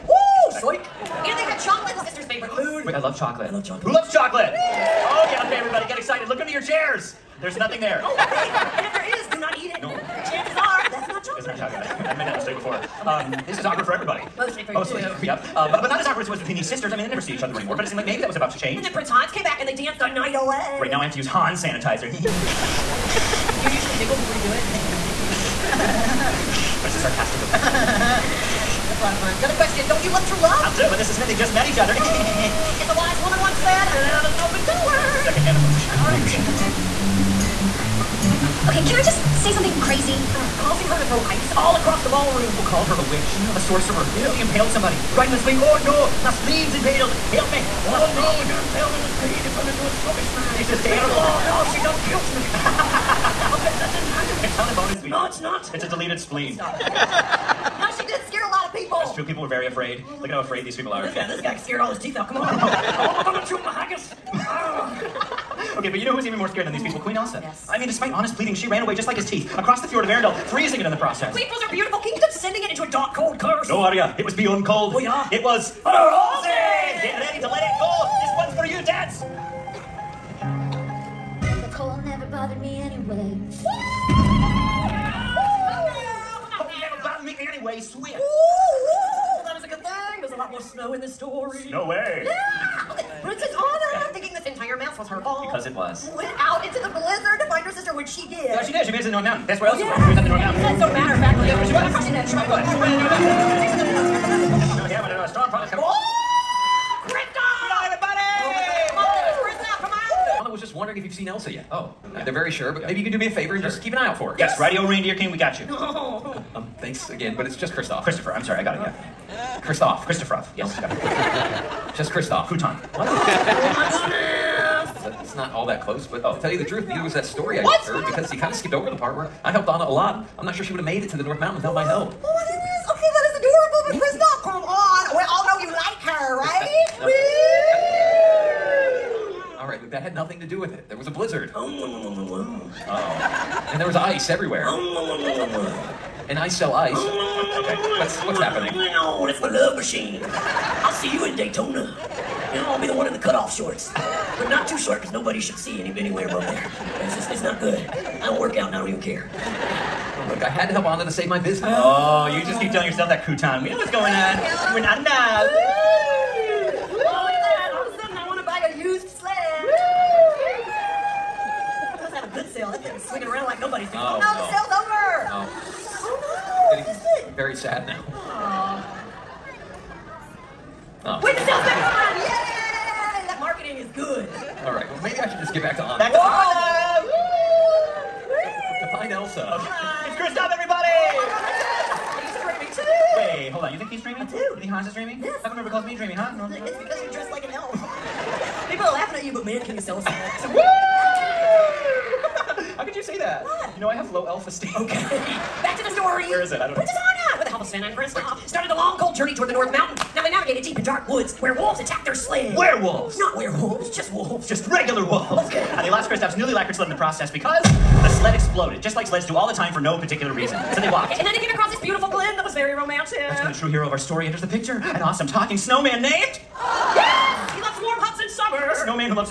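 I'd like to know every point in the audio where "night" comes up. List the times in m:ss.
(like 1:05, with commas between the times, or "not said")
0:20.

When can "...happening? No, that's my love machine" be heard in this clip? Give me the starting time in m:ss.
2:28.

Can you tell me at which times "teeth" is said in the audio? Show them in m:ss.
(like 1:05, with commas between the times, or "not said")
1:02, 1:09.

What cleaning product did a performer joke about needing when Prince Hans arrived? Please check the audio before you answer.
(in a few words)
Hans sanitizer.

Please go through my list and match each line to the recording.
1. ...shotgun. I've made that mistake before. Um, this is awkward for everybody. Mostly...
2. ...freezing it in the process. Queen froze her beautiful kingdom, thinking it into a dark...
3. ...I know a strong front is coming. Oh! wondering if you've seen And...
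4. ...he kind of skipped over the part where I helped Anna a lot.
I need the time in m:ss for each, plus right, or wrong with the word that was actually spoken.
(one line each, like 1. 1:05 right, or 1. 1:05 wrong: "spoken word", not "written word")
1. 0:11 right
2. 1:10 wrong: "sending", not "thinking"
3. 1:45 wrong: "Elsa", not "And"
4. 2:08 right.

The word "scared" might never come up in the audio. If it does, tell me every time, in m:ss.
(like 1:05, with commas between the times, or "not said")
1:01, 1:06.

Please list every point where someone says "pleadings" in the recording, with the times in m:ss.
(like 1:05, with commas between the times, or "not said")
1:08.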